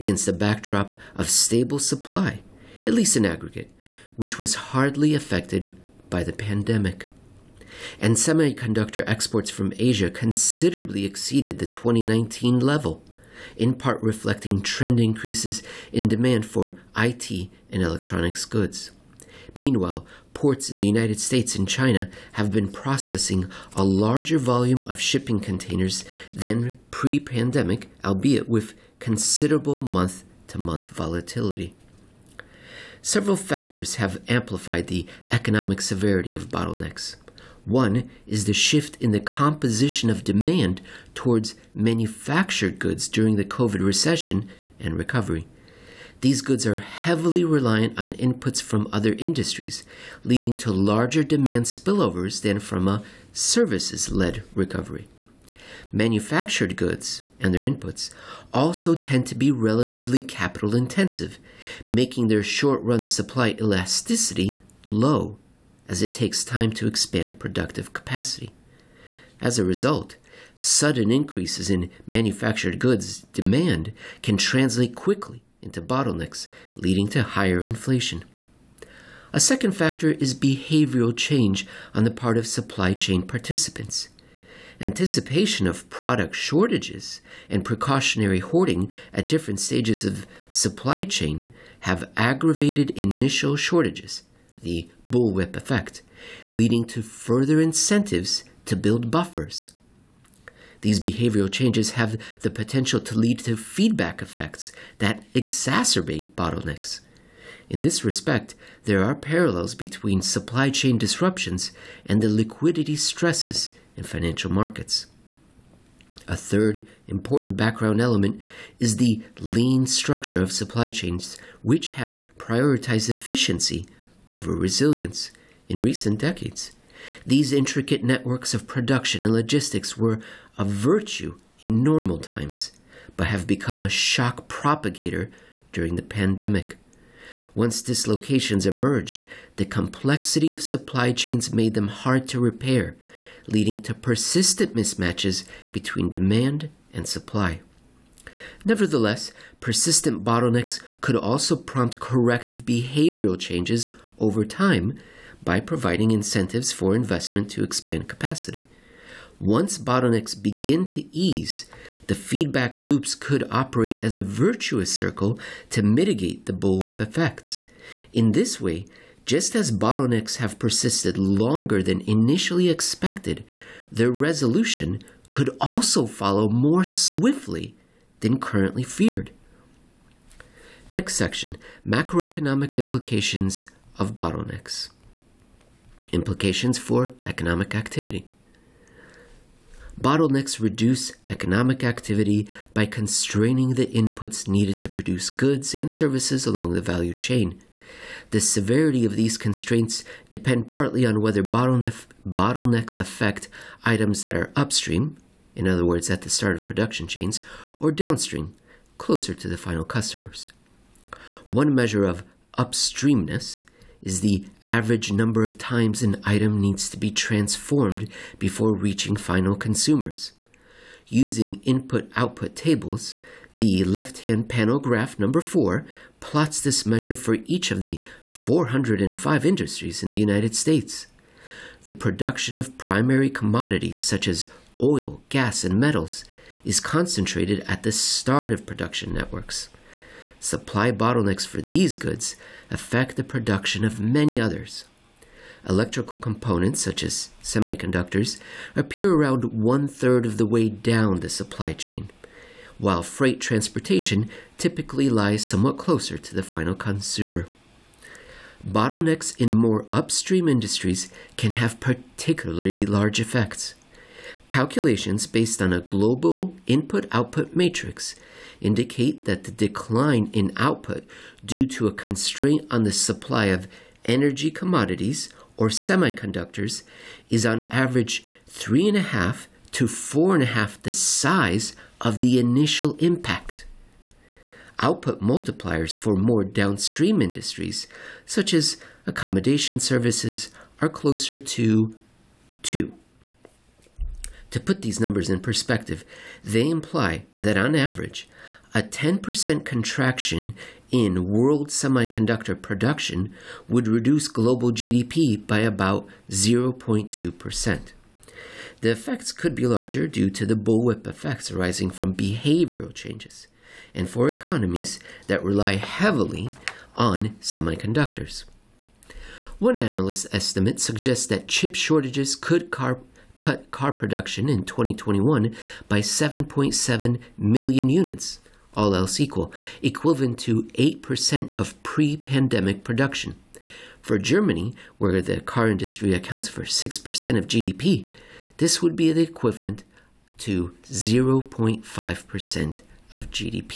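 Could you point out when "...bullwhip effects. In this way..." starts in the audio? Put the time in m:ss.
2:46.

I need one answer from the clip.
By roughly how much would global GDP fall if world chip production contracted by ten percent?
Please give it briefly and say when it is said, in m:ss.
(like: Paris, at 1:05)
0.2%, at 5:06.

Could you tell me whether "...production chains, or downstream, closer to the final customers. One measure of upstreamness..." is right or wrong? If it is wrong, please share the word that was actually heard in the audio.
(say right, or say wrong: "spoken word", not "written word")
right.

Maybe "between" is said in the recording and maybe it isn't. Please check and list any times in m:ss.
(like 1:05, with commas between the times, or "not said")
1:49, 2:25.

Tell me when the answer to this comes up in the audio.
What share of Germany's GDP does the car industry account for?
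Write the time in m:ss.
5:36.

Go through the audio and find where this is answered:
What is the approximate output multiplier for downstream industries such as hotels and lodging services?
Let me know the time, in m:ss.
4:52.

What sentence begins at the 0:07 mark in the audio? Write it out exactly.
And semiconductor exports from Asia considerably exceeded the 2019 level, in part reflecting trend increases in demand for IT and electronics goods.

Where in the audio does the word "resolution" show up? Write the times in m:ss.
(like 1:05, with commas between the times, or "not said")
2:54.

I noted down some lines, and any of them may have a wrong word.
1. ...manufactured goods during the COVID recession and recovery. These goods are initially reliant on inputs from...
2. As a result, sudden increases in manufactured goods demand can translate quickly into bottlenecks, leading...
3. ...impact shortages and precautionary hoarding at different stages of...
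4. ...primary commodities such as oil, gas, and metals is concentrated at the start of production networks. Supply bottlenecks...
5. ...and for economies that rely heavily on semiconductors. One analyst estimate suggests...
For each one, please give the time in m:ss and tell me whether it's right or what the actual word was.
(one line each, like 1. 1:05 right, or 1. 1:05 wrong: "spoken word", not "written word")
1. 0:41 wrong: "heavily", not "initially"
2. 1:09 right
3. 1:25 wrong: "product", not "impact"
4. 3:52 right
5. 5:13 right.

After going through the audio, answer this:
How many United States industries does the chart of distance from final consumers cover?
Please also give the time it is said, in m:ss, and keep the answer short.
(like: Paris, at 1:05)
405, at 3:48.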